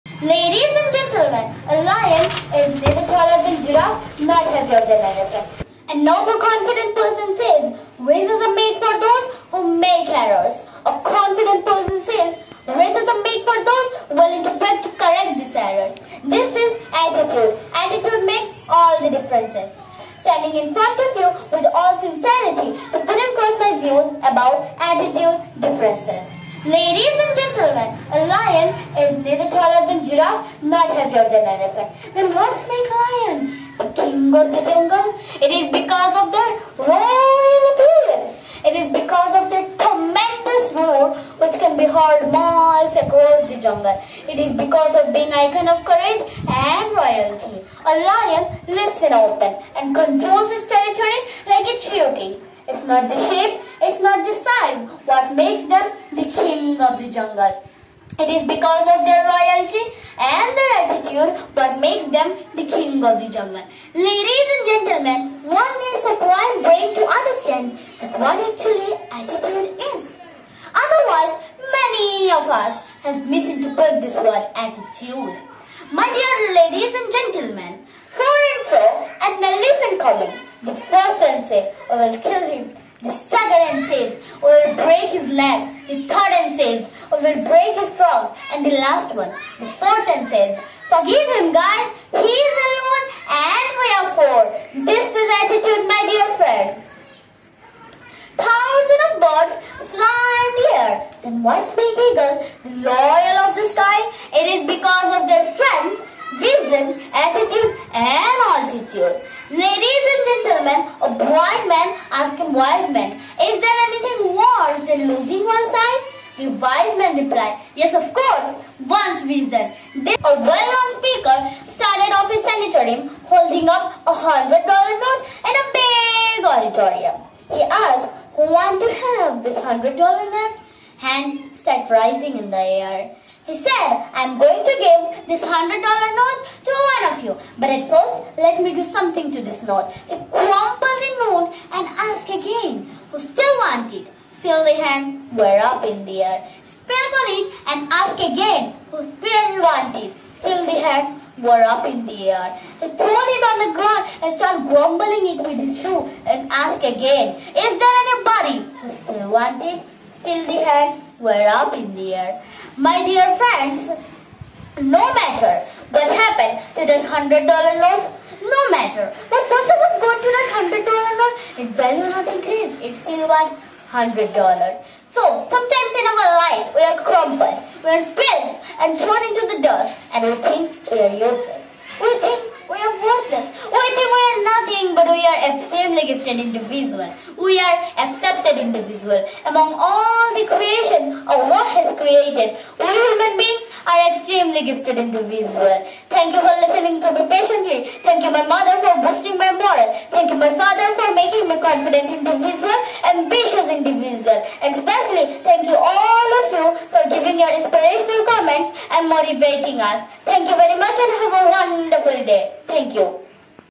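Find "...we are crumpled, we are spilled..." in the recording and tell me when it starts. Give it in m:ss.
2:56.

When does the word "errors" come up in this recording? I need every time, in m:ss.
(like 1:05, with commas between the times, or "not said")
0:10, 0:15.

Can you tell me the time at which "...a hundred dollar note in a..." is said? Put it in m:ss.
2:04.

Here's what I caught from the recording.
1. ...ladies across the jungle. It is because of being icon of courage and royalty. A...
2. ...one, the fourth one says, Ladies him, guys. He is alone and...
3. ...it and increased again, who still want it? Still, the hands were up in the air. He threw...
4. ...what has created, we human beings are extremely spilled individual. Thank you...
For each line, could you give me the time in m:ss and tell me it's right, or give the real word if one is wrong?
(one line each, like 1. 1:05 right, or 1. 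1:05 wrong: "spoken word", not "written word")
1. 0:42 wrong: "miles", not "ladies"
2. 1:29 wrong: "Forgive", not "Ladies"
3. 2:27 wrong: "asked", not "increased"
4. 3:11 wrong: "gifted", not "spilled".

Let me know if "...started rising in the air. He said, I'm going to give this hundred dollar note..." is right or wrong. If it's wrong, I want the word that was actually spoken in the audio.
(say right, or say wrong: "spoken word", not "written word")
right.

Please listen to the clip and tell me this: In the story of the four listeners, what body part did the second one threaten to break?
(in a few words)
his leg.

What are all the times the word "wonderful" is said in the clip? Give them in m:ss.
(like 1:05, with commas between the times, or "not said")
3:31.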